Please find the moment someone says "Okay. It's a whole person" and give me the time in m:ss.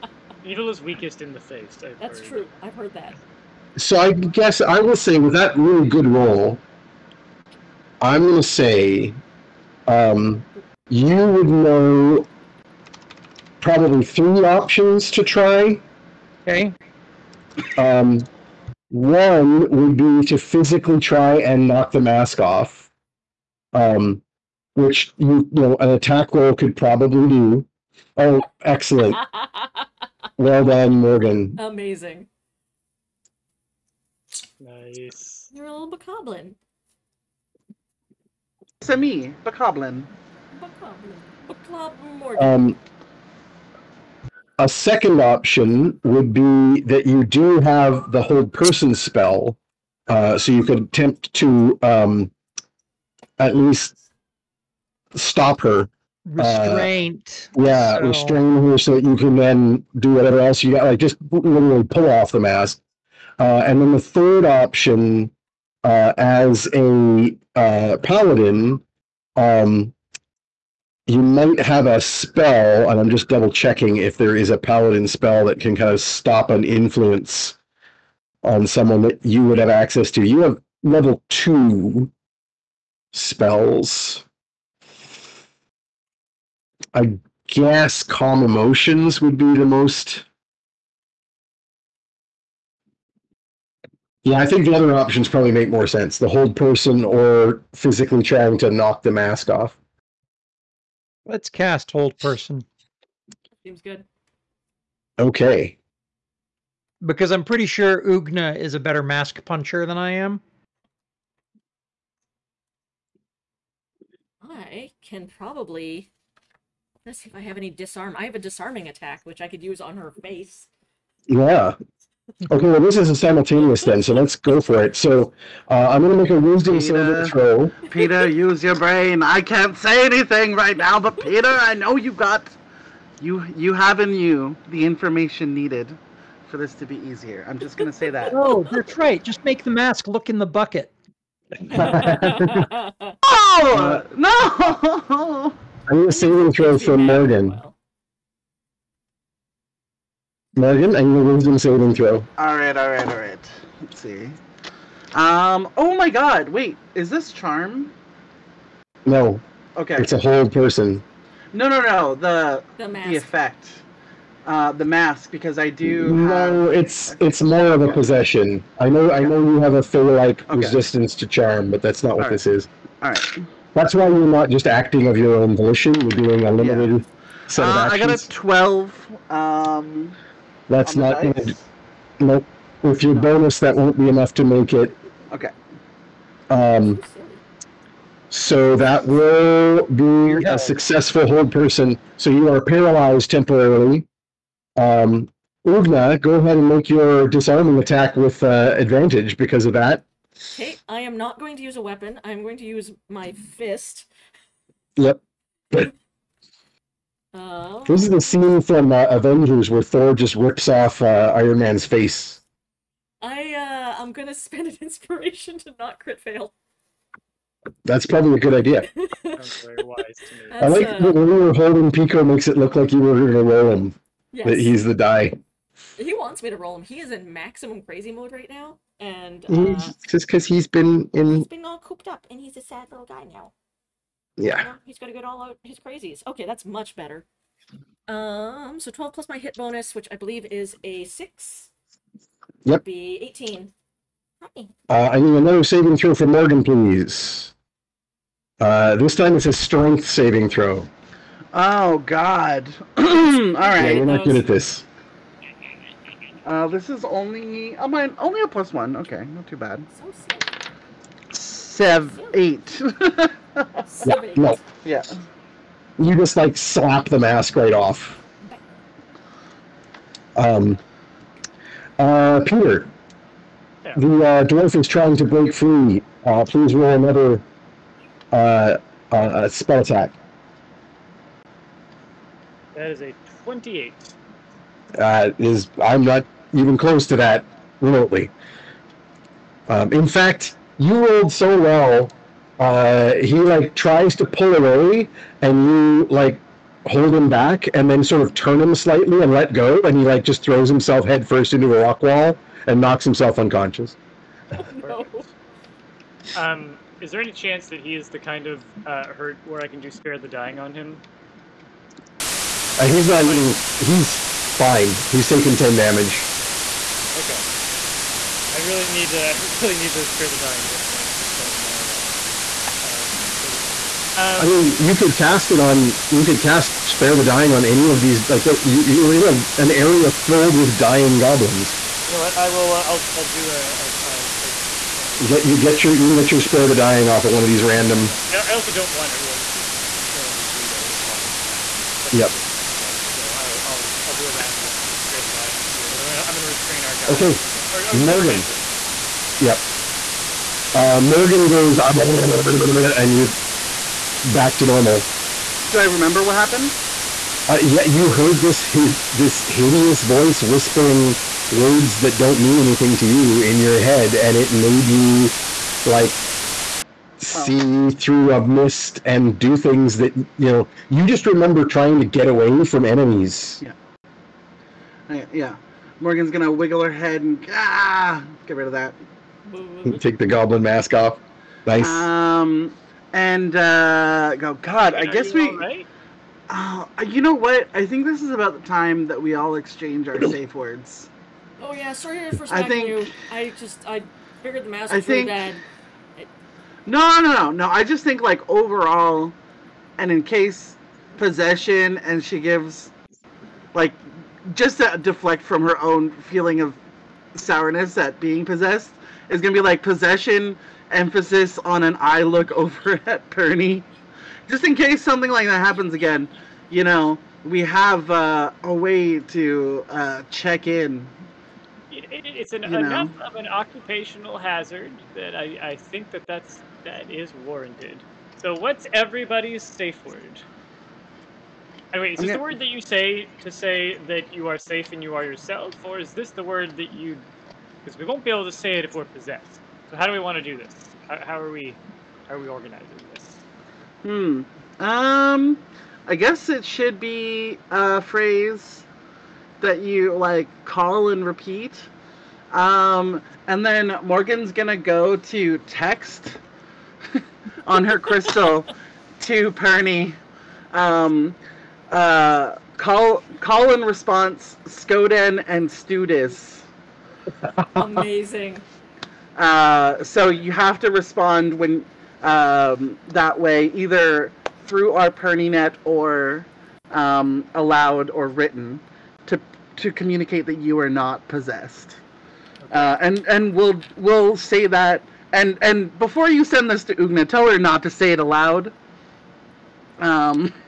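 2:39.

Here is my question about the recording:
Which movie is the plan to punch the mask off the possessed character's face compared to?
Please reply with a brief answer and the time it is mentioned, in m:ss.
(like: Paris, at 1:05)
Avengers, at 3:29.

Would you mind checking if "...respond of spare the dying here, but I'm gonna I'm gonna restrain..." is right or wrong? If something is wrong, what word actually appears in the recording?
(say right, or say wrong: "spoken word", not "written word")
wrong: "round", not "respond".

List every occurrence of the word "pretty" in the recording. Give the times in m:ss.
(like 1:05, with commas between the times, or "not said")
1:47.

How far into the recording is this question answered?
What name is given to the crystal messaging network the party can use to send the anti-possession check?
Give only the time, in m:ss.
7:55.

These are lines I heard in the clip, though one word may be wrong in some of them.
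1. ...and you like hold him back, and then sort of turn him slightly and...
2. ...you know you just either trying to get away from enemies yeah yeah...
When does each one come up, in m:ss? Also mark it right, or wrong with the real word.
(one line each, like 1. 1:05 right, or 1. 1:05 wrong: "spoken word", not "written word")
1. 4:55 right
2. 6:10 wrong: "remember", not "either".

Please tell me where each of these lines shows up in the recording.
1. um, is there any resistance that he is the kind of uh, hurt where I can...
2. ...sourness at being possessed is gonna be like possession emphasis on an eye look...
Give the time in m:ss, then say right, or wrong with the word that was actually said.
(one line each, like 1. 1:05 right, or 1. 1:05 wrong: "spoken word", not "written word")
1. 5:06 wrong: "chance", not "resistance"
2. 6:47 right.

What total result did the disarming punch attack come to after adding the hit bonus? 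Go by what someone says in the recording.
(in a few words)
18.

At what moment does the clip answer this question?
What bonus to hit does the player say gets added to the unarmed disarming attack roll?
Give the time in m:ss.
4:00.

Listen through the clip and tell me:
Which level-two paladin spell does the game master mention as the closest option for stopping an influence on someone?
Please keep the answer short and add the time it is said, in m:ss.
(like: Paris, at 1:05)
Calm emotions, at 1:28.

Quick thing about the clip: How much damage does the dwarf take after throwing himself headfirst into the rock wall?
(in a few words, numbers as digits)
10.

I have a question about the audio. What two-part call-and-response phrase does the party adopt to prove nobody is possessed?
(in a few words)
Skoden and Studis.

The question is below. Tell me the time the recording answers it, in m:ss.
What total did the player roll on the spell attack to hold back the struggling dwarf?
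4:43.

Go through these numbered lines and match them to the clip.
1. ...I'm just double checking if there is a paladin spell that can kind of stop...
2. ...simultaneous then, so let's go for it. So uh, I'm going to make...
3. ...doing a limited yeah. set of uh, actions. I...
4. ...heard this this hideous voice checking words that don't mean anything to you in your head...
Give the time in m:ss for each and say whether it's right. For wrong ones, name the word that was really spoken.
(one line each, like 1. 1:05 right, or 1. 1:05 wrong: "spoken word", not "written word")
1. 1:13 right
2. 2:03 right
3. 2:56 right
4. 5:58 wrong: "whispering", not "checking".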